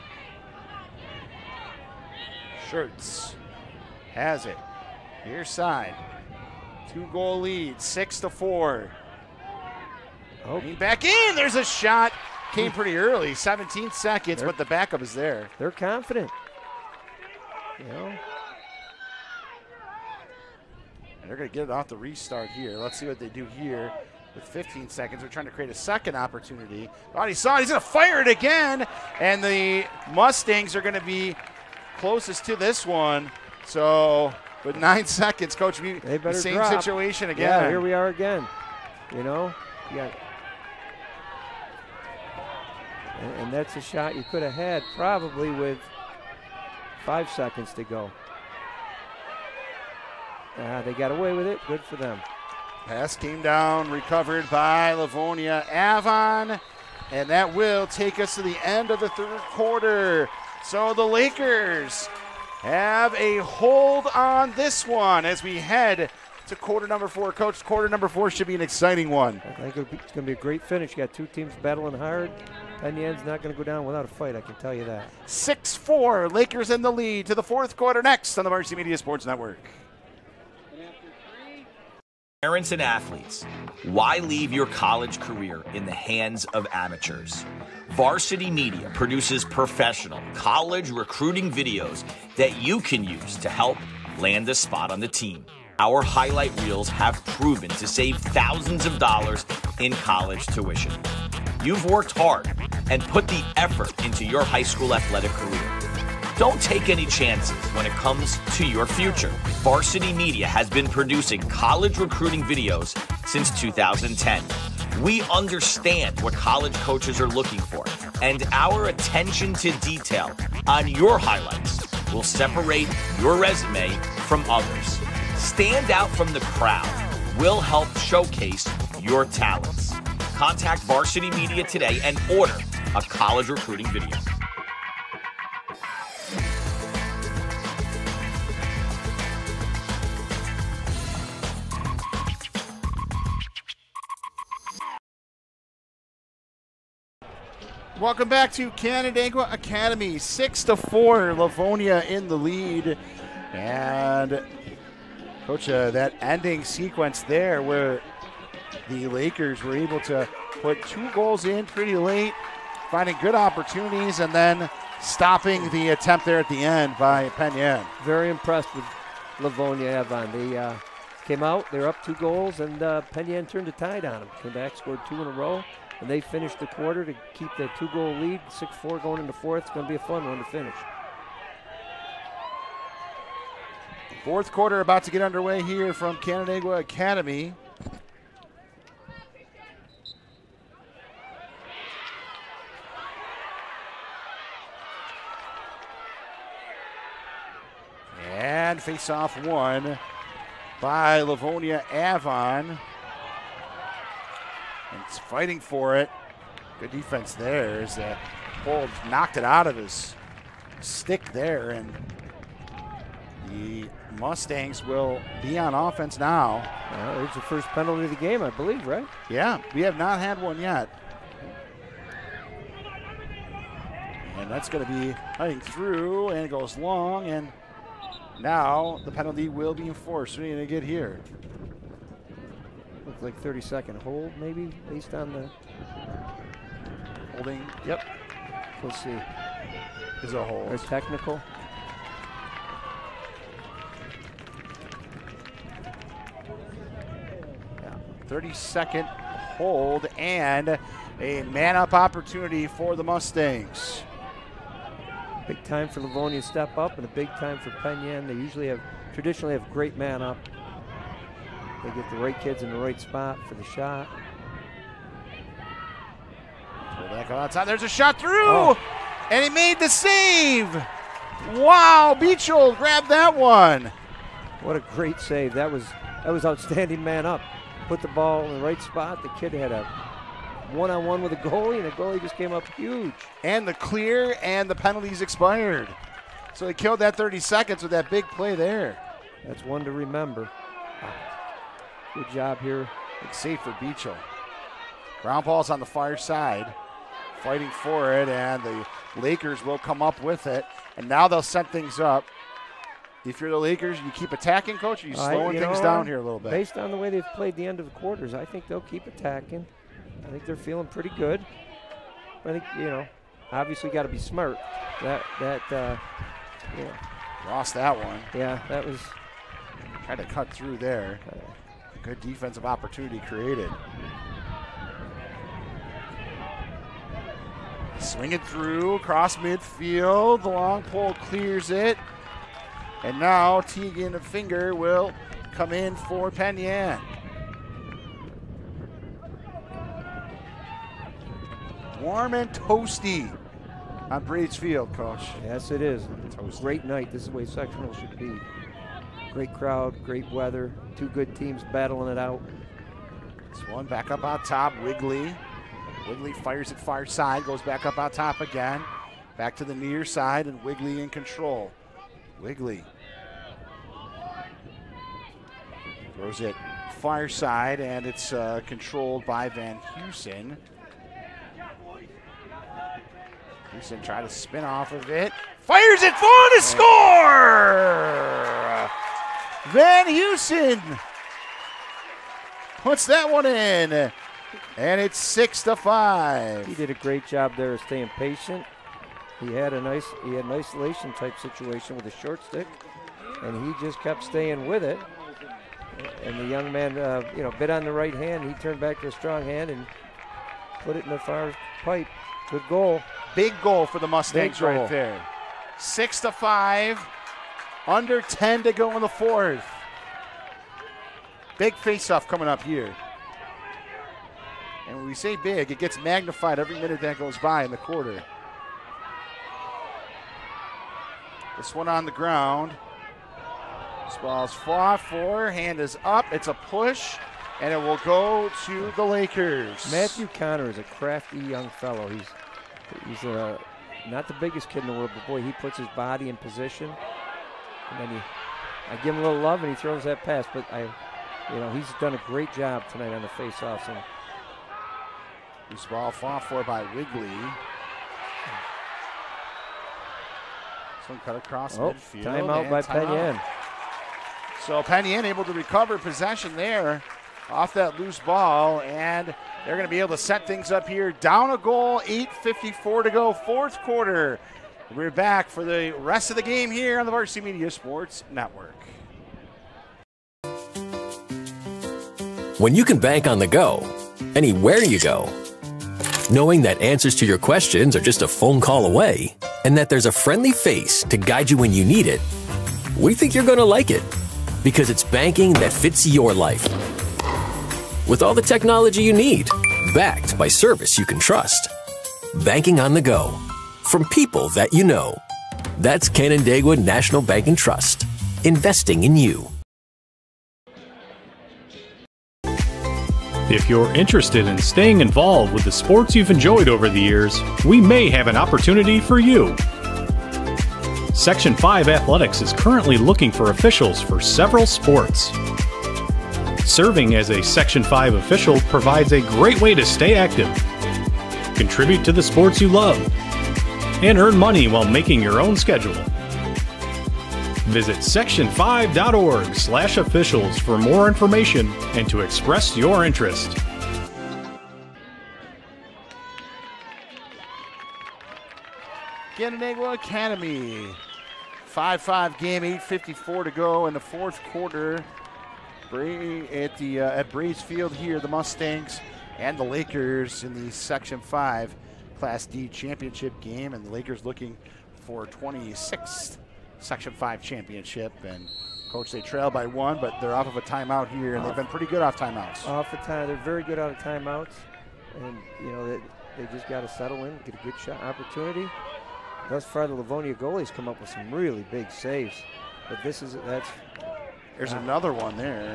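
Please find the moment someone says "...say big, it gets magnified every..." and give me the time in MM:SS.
06:55.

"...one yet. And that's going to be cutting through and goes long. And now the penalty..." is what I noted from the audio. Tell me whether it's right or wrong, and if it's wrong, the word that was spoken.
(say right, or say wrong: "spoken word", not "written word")
right.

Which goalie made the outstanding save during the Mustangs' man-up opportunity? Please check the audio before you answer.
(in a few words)
Beachell.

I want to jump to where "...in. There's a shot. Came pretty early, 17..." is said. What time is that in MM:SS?
00:11.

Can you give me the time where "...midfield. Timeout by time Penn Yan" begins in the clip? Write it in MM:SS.
07:31.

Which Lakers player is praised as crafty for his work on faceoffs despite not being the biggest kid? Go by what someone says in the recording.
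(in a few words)
Matthew Connor.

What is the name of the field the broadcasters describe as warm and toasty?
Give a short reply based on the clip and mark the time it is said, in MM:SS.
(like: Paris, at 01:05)
Breeds Field, at 05:44.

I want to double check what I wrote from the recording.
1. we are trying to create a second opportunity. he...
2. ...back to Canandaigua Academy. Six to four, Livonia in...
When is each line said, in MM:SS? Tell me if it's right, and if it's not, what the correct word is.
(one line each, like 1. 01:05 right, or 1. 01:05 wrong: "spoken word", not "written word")
1. 00:25 right
2. 02:28 right.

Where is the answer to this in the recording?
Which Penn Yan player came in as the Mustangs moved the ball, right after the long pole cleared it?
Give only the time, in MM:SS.
05:33.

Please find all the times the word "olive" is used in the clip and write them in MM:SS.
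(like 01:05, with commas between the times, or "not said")
not said.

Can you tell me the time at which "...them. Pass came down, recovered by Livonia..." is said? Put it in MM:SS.
00:51.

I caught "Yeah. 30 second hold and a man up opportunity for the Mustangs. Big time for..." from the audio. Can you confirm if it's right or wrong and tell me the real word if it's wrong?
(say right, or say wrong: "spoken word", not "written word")
right.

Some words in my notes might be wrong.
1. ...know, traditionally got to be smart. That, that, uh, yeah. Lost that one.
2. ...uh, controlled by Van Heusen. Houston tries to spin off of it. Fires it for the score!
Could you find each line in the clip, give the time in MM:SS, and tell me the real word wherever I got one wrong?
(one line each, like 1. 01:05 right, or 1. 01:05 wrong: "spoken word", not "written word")
1. 05:12 wrong: "obviously", not "traditionally"
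2. 06:08 right.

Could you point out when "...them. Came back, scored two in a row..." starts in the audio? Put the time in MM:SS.
02:54.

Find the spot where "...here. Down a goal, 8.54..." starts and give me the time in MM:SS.
07:40.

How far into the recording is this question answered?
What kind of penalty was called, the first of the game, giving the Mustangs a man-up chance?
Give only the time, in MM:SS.
03:57.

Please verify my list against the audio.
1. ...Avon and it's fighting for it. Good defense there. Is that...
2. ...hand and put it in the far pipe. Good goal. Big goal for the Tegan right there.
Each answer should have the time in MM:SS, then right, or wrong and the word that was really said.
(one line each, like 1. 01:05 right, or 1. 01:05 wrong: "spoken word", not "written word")
1. 03:21 right
2. 06:39 wrong: "Mustangs", not "Tegan".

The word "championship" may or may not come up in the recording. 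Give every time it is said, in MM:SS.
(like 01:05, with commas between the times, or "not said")
09:12, 09:17.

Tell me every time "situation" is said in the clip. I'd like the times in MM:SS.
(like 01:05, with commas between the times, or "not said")
00:36, 06:31.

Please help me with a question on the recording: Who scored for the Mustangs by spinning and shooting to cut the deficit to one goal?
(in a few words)
Van Houston.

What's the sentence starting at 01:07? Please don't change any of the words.
Coach, quarter number four should be an exciting one.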